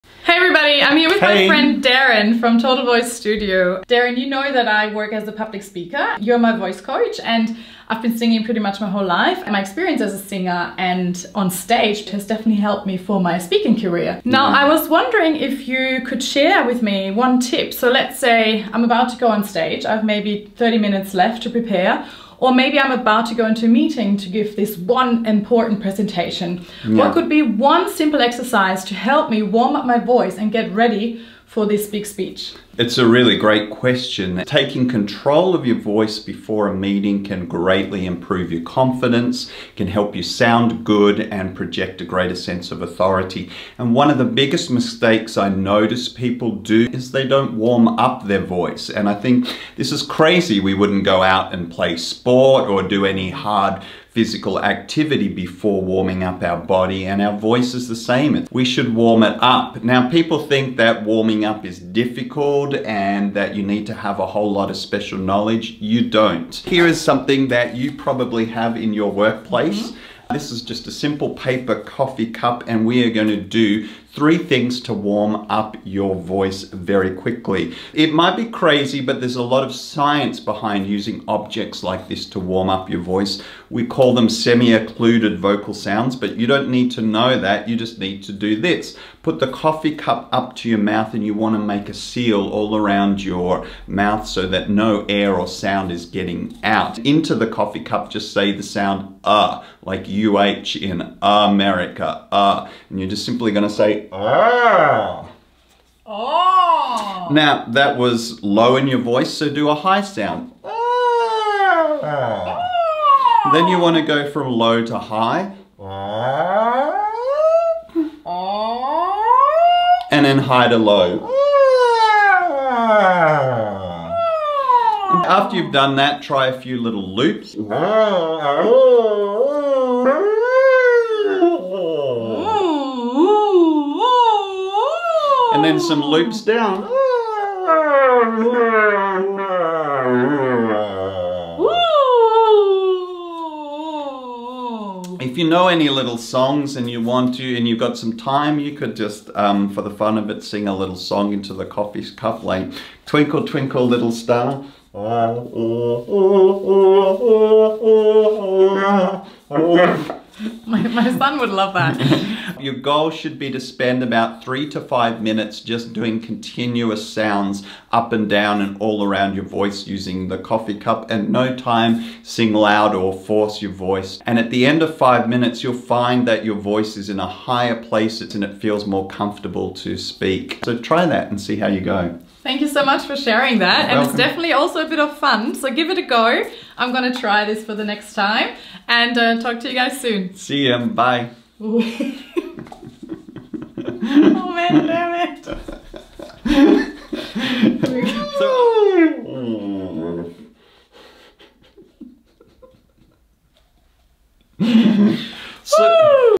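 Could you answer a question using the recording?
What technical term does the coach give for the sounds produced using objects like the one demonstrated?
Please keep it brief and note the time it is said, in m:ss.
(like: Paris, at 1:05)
semi-occluded vocal sounds, at 1:24.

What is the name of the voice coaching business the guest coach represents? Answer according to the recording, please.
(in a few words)
Total Voice Studio.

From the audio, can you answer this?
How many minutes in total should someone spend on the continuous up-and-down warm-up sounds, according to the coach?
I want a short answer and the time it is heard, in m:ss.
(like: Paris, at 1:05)
3 to 5 minutes, at 2:44.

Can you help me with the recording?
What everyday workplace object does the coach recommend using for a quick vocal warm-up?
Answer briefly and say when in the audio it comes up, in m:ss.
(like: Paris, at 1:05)
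paper coffee cup, at 1:11.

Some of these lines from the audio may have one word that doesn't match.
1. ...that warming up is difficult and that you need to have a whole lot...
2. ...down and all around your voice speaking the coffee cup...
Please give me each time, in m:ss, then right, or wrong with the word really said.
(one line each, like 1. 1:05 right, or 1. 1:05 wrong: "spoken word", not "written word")
1. 1:00 right
2. 2:48 wrong: "using", not "speaking".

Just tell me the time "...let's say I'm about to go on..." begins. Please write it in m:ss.
0:17.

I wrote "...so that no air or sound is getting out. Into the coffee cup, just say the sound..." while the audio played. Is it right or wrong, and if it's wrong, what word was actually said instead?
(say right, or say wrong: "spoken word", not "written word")
right.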